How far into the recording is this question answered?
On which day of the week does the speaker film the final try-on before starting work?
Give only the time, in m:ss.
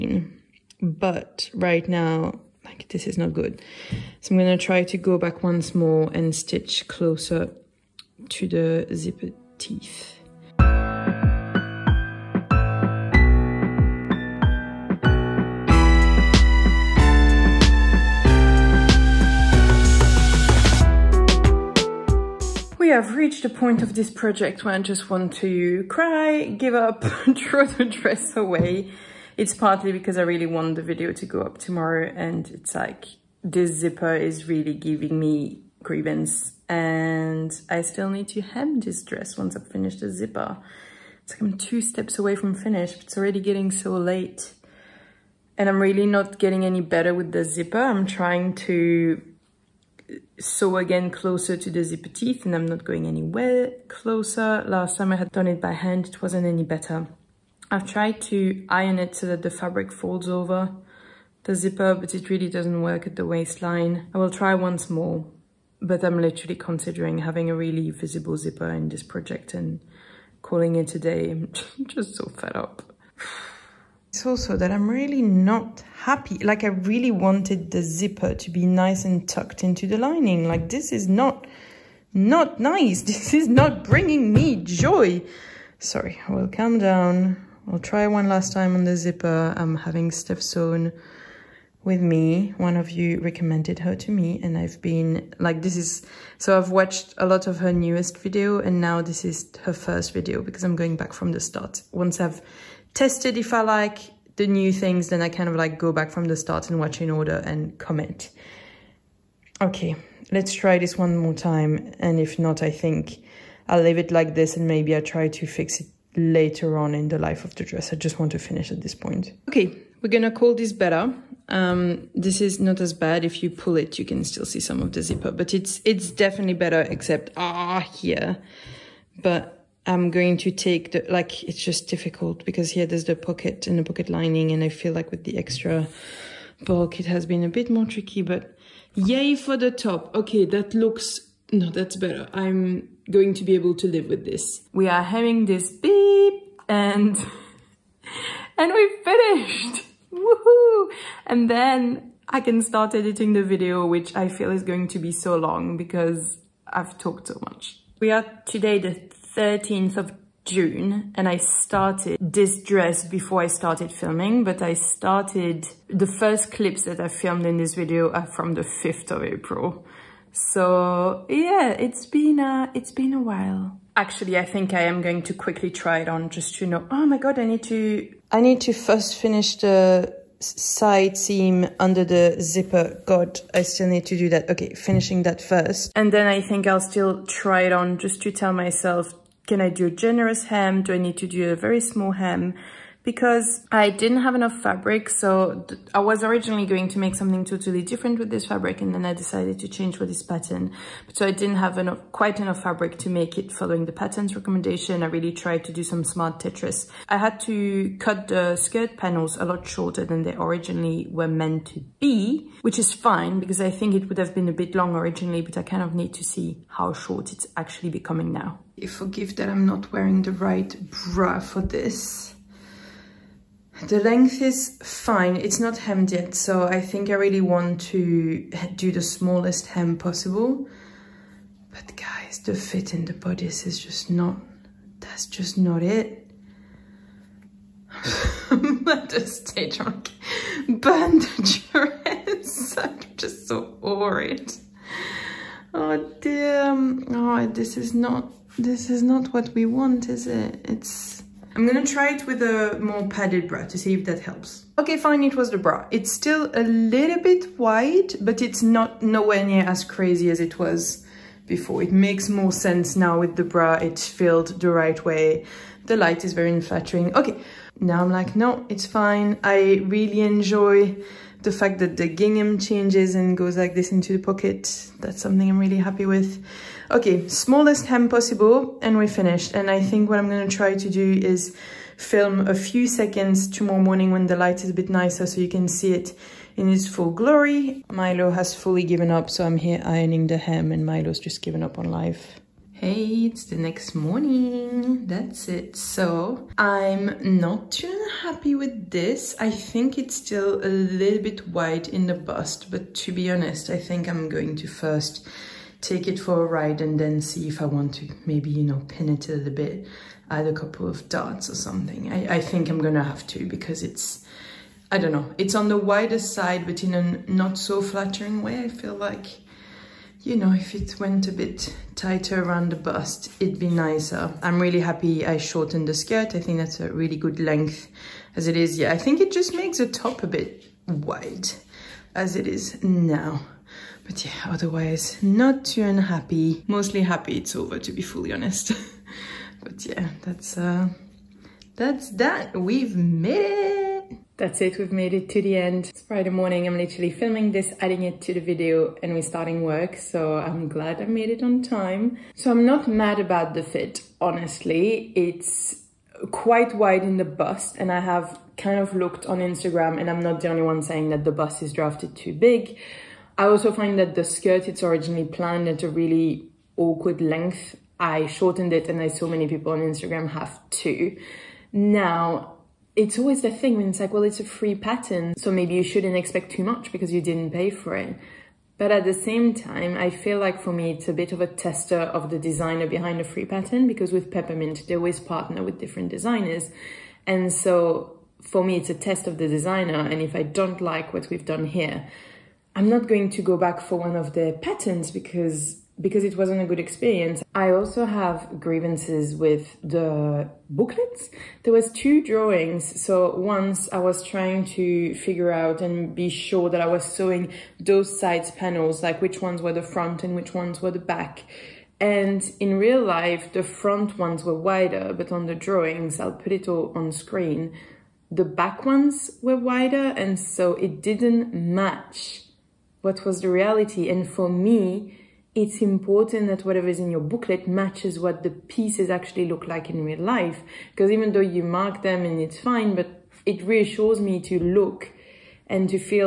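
5:46.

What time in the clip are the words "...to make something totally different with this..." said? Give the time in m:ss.
3:16.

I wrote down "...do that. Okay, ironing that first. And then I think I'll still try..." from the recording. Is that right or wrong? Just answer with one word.
wrong.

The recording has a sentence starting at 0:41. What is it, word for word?
It's like I'm two steps away from finish, but it's already getting so late.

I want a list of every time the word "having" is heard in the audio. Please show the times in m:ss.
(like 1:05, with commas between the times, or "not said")
1:07, 1:29, 2:25.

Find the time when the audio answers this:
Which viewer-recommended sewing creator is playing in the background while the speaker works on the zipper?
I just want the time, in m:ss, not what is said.
1:30.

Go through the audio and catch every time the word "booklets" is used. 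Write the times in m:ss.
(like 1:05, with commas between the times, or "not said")
6:40, 7:07.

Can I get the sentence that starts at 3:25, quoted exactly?
I really tried to do some smart Tetris.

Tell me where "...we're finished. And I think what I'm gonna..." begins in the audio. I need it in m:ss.
4:38.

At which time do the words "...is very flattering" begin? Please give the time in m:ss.
4:26.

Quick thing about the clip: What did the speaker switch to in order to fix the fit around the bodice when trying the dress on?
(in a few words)
a more padded bra.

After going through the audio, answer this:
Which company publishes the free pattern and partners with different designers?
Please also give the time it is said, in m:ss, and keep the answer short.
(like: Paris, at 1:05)
Peppermint, at 6:24.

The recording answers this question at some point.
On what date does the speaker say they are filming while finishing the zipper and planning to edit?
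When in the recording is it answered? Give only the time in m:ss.
2:39.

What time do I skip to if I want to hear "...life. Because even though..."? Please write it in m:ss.
7:10.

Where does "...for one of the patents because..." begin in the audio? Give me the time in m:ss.
6:33.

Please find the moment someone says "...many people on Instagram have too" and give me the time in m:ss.
6:09.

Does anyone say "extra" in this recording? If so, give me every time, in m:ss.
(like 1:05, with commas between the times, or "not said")
2:15.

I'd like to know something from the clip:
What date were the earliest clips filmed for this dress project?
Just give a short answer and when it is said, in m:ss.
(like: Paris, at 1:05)
5th of April, at 2:48.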